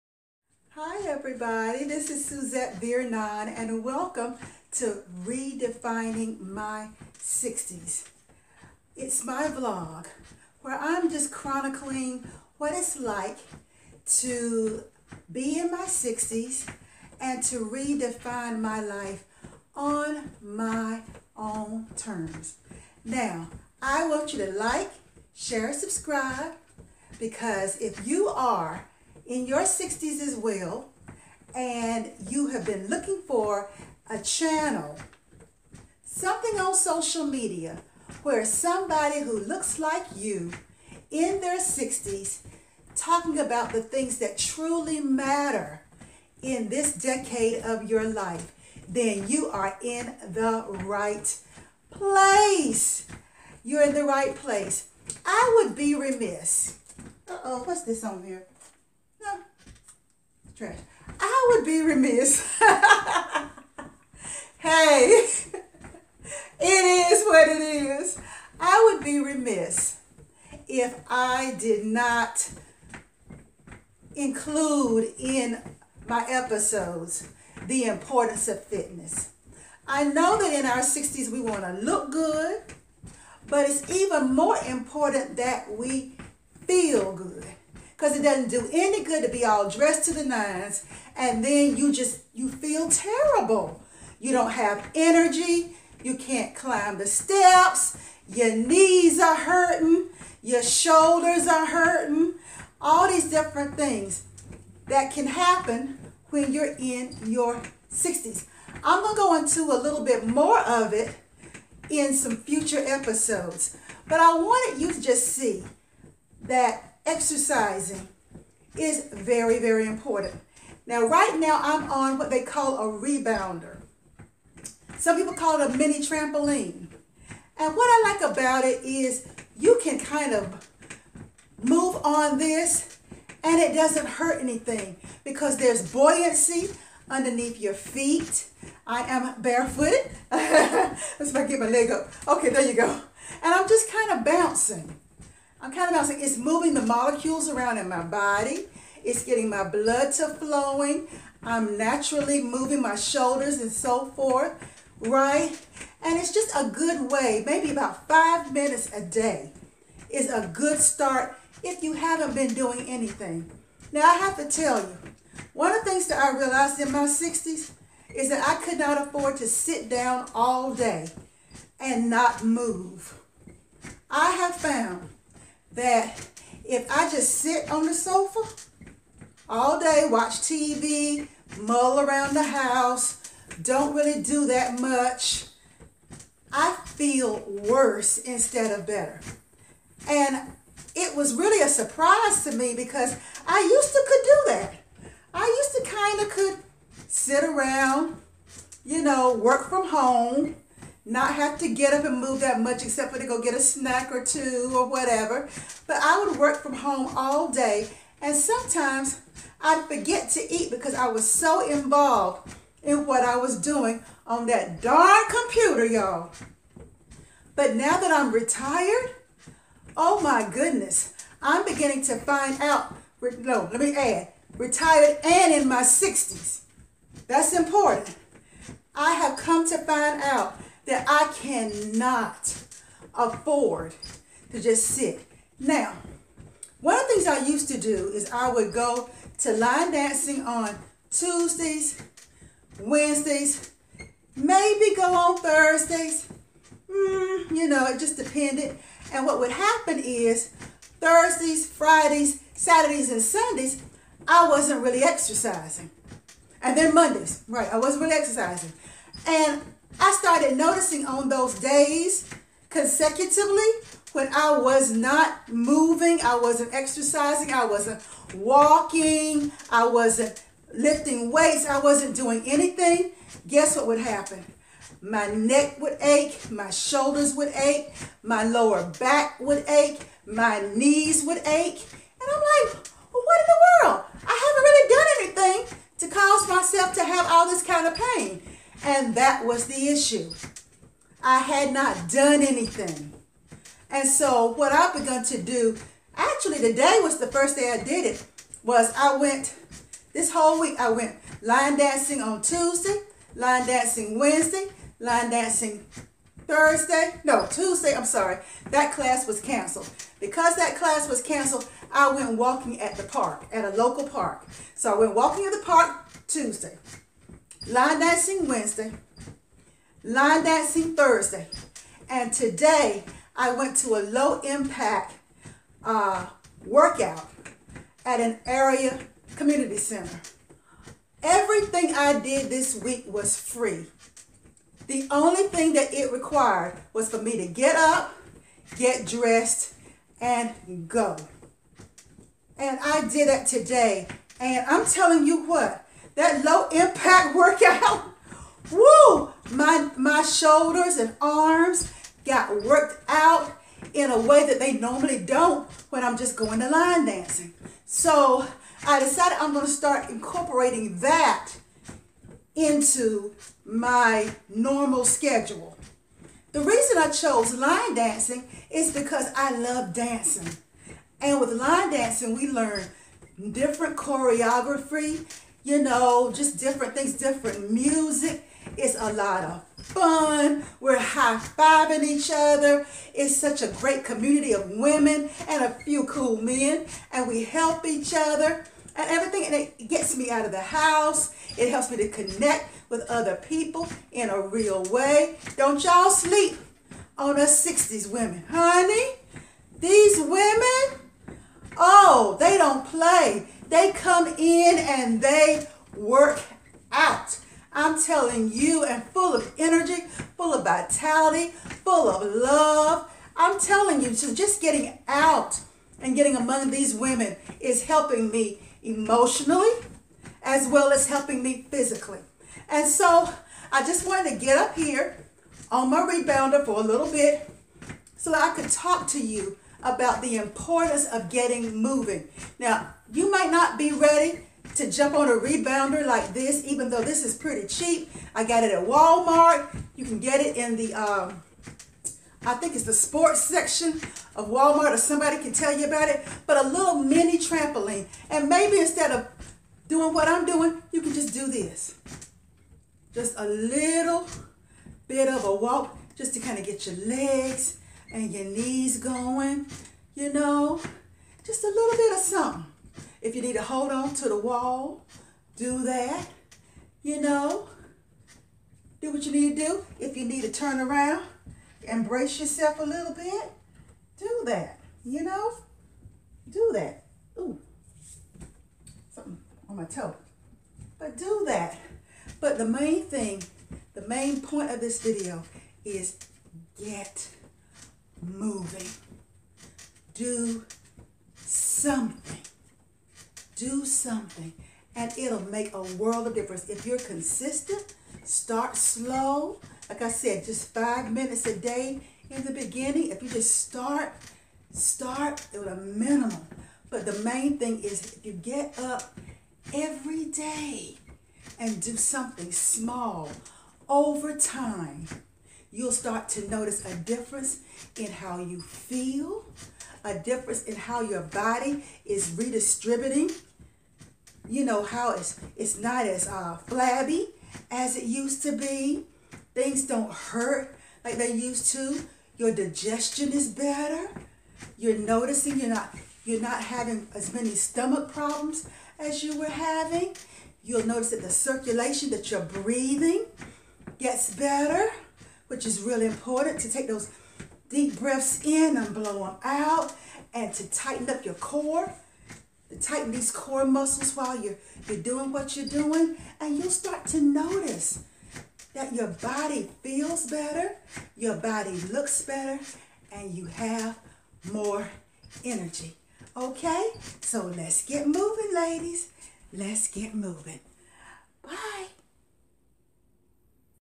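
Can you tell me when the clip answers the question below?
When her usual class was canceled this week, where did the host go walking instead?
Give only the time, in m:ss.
5:13.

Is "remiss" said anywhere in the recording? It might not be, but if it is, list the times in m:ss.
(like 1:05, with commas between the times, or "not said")
0:55, 1:01, 1:09.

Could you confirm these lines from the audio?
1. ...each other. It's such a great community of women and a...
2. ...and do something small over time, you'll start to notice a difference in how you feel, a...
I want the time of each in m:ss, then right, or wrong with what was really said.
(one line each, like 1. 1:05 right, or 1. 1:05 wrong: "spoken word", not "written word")
1. 6:22 right
2. 8:31 right.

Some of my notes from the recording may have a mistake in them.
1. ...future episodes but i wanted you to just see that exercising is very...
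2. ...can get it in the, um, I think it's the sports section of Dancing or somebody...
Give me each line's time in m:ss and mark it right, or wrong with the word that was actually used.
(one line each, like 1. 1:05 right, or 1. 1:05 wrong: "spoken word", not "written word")
1. 1:52 right
2. 7:20 wrong: "Walmart", not "Dancing".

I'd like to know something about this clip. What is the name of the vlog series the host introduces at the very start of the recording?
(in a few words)
Redefining My 60s.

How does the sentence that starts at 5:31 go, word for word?
Everything I did this week was free.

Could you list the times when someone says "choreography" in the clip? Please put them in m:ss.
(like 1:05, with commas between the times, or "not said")
6:13.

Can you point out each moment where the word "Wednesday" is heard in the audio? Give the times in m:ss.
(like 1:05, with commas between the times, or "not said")
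4:02, 5:04, 5:18.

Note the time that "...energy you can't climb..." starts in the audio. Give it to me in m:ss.
1:34.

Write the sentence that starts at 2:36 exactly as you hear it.
And it's just a good way, maybe about five minutes a day is a good start if you haven't been doing anything.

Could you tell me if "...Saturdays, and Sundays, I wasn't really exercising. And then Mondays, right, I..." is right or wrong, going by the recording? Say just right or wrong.
right.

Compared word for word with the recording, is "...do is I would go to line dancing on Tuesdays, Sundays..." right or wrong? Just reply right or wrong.
wrong.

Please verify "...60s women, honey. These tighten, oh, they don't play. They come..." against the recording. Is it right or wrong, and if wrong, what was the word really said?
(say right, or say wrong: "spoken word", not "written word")
wrong: "women", not "tighten".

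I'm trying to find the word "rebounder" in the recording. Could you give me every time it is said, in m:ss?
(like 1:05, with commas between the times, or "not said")
2:02, 7:06, 7:15.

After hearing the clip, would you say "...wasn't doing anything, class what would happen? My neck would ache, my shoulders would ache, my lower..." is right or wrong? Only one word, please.
wrong.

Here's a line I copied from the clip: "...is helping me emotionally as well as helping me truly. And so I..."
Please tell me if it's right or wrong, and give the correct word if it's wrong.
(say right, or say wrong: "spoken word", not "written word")
wrong: "physically", not "truly".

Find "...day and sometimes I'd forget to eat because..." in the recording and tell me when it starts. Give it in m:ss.
3:27.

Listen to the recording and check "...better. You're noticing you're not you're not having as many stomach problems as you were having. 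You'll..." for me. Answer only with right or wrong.
right.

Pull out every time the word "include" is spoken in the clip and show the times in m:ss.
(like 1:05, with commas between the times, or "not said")
1:14.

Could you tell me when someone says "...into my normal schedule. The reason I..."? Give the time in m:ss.
6:02.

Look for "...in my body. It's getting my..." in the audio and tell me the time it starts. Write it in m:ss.
2:27.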